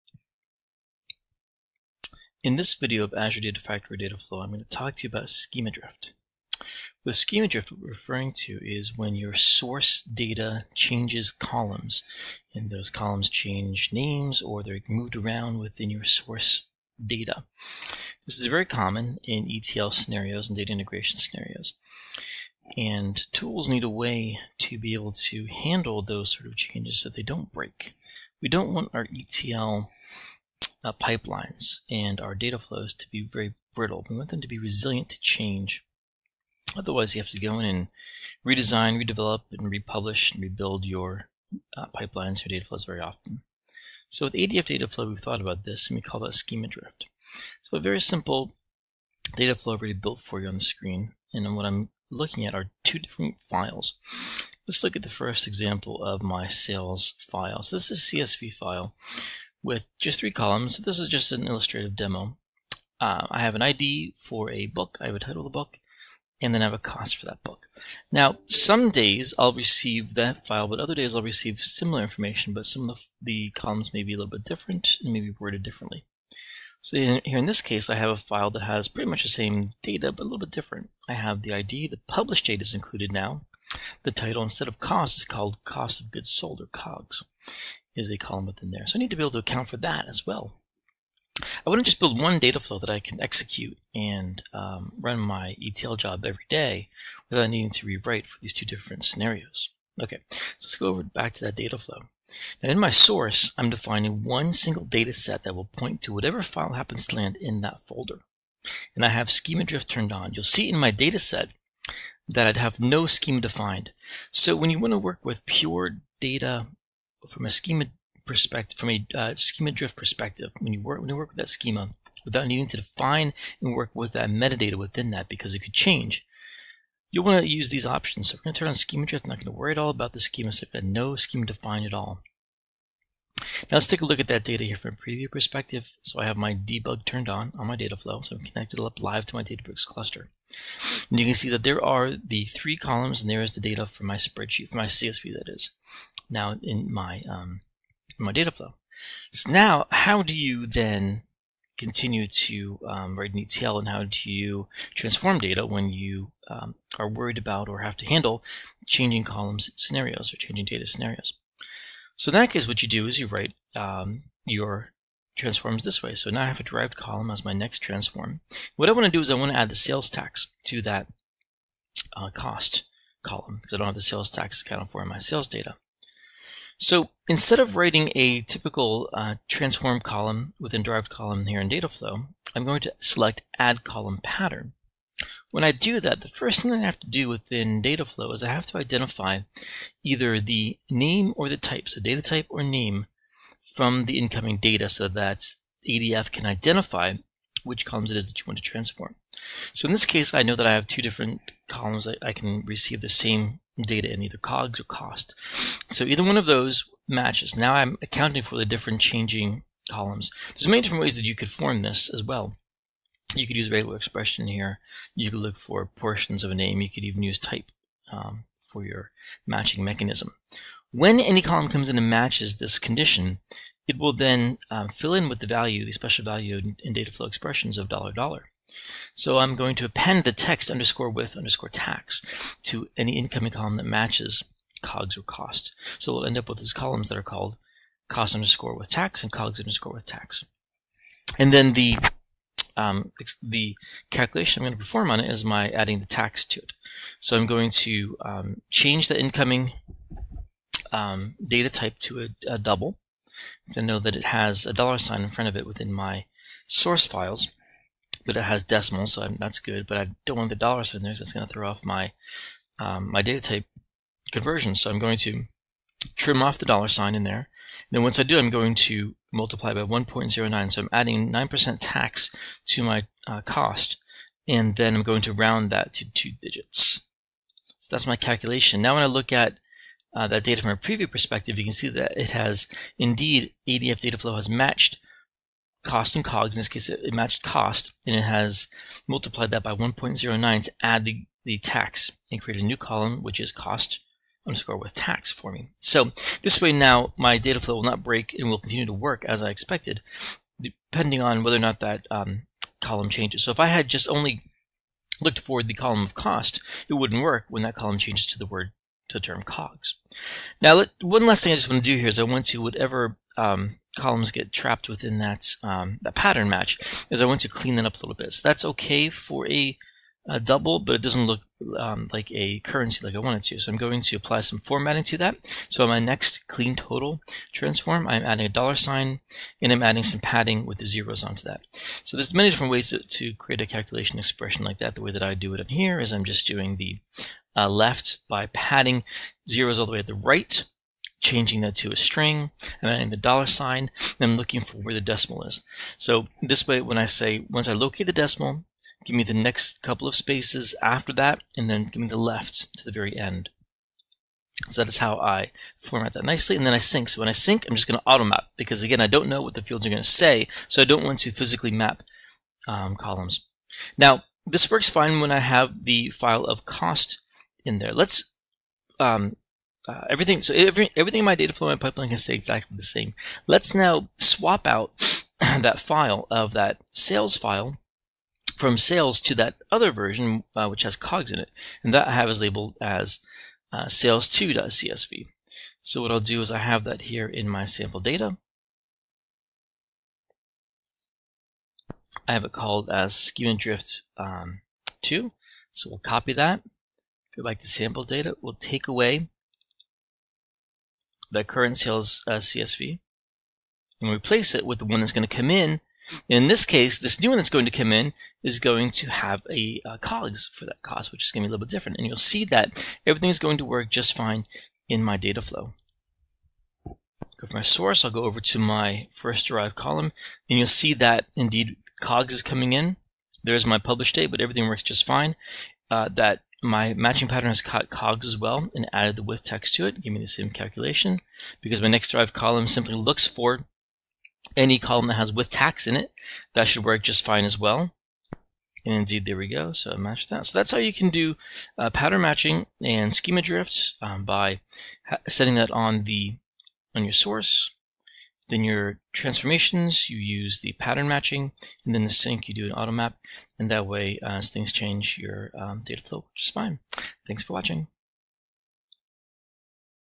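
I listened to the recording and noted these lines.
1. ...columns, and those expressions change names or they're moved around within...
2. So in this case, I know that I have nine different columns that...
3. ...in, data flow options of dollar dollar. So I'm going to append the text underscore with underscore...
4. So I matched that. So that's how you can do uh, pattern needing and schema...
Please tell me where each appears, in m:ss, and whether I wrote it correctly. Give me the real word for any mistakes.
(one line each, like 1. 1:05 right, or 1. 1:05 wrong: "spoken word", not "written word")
1. 0:11 wrong: "columns", not "expressions"
2. 3:19 wrong: "two", not "nine"
3. 3:46 wrong: "expressions", not "options"
4. 7:19 wrong: "matching", not "needing".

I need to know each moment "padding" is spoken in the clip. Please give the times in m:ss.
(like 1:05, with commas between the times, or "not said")
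5:30, 5:38.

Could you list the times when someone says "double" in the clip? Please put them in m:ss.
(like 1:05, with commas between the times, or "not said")
4:12, 5:20.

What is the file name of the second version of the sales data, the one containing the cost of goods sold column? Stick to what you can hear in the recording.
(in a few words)
sales2.csv.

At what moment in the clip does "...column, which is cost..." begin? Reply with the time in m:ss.
4:52.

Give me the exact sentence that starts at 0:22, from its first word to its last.
And tools need a way to be able to handle those sort of changes so they don't break.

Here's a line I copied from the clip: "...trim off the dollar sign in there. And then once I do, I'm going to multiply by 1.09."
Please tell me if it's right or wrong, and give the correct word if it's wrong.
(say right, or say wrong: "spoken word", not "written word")
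right.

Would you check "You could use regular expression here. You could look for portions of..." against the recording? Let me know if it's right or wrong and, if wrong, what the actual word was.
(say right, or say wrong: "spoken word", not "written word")
right.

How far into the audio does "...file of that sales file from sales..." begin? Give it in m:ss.
6:15.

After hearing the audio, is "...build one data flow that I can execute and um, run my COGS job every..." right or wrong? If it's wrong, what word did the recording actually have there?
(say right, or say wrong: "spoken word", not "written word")
wrong: "ETL", not "COGS".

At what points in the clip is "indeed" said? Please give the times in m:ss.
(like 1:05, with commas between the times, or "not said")
4:42, 7:01, 7:18.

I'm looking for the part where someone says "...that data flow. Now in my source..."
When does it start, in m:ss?
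1:41.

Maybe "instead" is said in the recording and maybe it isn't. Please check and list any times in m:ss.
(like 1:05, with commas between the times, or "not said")
1:24, 2:57.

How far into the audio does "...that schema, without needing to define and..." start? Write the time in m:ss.
2:01.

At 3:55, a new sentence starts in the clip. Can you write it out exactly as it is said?
So we'll end up with these columns that are called cost underscore with tax and cogs underscore with tax.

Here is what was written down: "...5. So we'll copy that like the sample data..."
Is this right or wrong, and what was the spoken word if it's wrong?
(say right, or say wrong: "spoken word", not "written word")
wrong: "2", not "5".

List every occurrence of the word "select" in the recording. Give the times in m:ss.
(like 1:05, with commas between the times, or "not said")
3:02.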